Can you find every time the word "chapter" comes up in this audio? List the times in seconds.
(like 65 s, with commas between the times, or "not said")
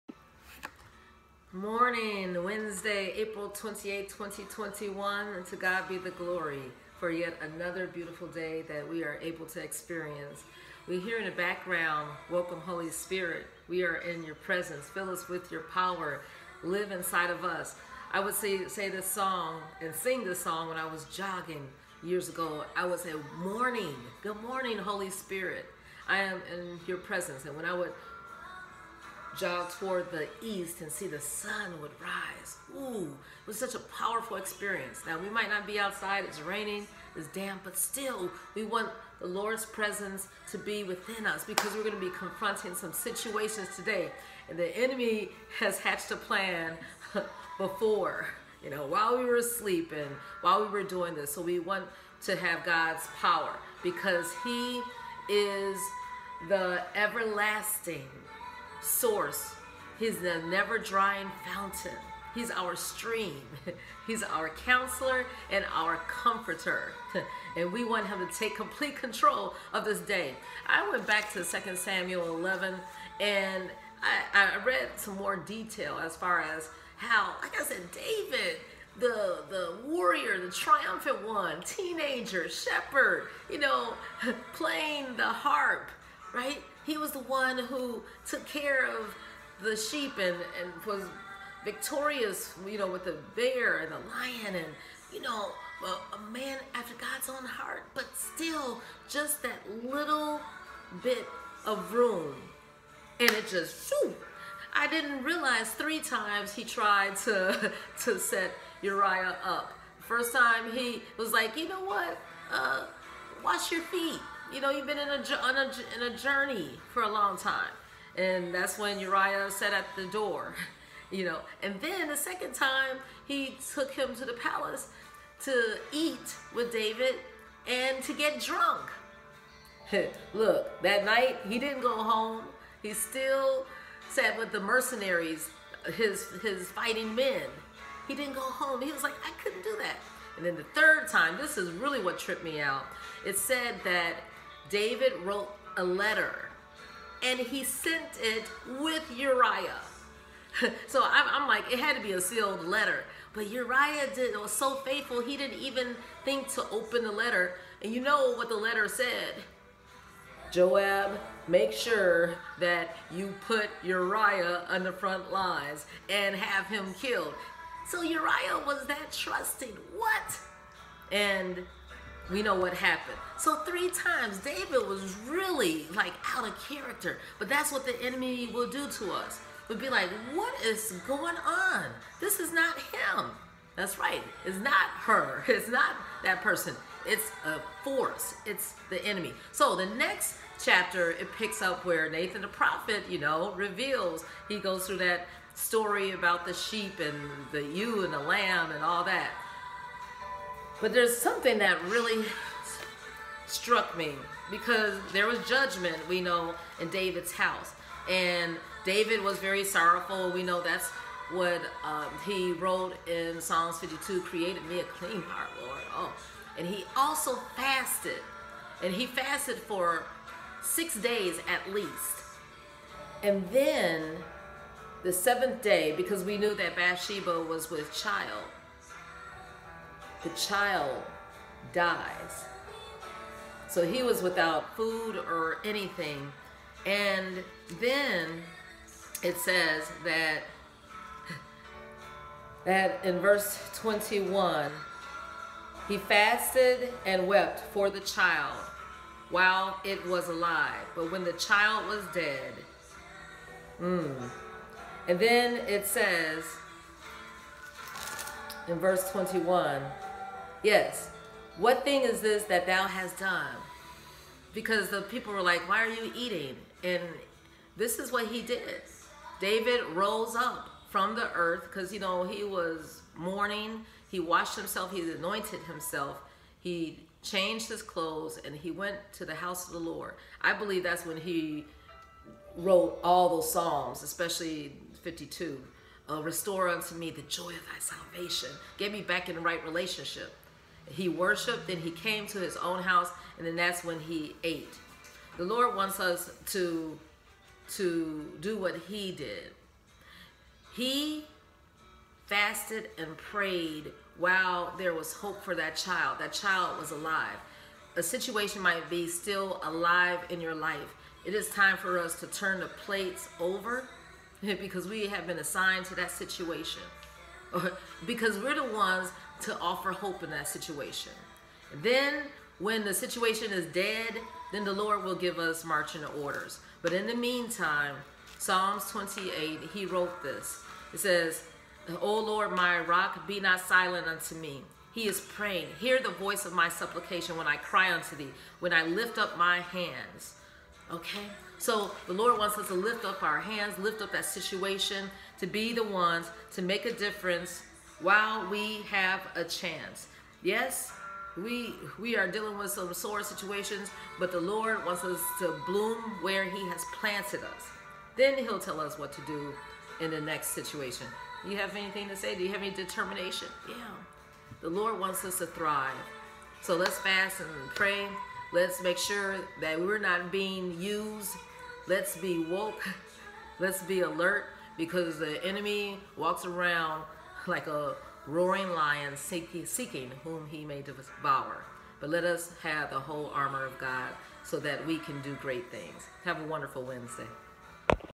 190 s.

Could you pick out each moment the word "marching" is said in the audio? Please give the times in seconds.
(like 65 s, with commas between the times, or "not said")
325 s.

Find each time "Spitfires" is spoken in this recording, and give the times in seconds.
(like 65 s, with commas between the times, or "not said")
not said.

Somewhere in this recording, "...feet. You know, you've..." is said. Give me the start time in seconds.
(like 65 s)
113 s.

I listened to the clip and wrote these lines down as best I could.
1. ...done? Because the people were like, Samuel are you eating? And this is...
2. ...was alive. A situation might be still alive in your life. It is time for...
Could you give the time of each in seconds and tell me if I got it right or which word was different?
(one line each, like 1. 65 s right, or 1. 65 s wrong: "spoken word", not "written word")
1. 263 s wrong: "Why", not "Samuel"
2. 306 s right.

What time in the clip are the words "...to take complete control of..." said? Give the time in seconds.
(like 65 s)
68 s.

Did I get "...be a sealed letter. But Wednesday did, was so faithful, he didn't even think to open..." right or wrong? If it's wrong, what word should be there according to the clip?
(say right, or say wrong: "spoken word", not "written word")
wrong: "Uriah", not "Wednesday".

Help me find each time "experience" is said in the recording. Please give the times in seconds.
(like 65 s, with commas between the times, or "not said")
9 s, 34 s.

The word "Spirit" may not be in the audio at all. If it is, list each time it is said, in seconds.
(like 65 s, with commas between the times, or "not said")
12 s, 25 s.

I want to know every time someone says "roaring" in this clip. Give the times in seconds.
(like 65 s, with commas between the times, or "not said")
378 s.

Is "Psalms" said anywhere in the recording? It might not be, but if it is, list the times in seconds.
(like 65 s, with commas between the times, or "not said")
213 s, 283 s, 328 s.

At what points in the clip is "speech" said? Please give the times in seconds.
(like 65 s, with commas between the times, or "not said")
not said.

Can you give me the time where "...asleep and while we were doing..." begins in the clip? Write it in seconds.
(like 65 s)
49 s.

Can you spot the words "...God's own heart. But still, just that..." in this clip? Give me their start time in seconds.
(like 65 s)
96 s.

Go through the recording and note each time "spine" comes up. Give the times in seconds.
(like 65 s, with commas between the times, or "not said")
not said.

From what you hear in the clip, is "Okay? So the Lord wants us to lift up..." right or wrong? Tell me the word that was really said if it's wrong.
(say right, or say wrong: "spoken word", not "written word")
right.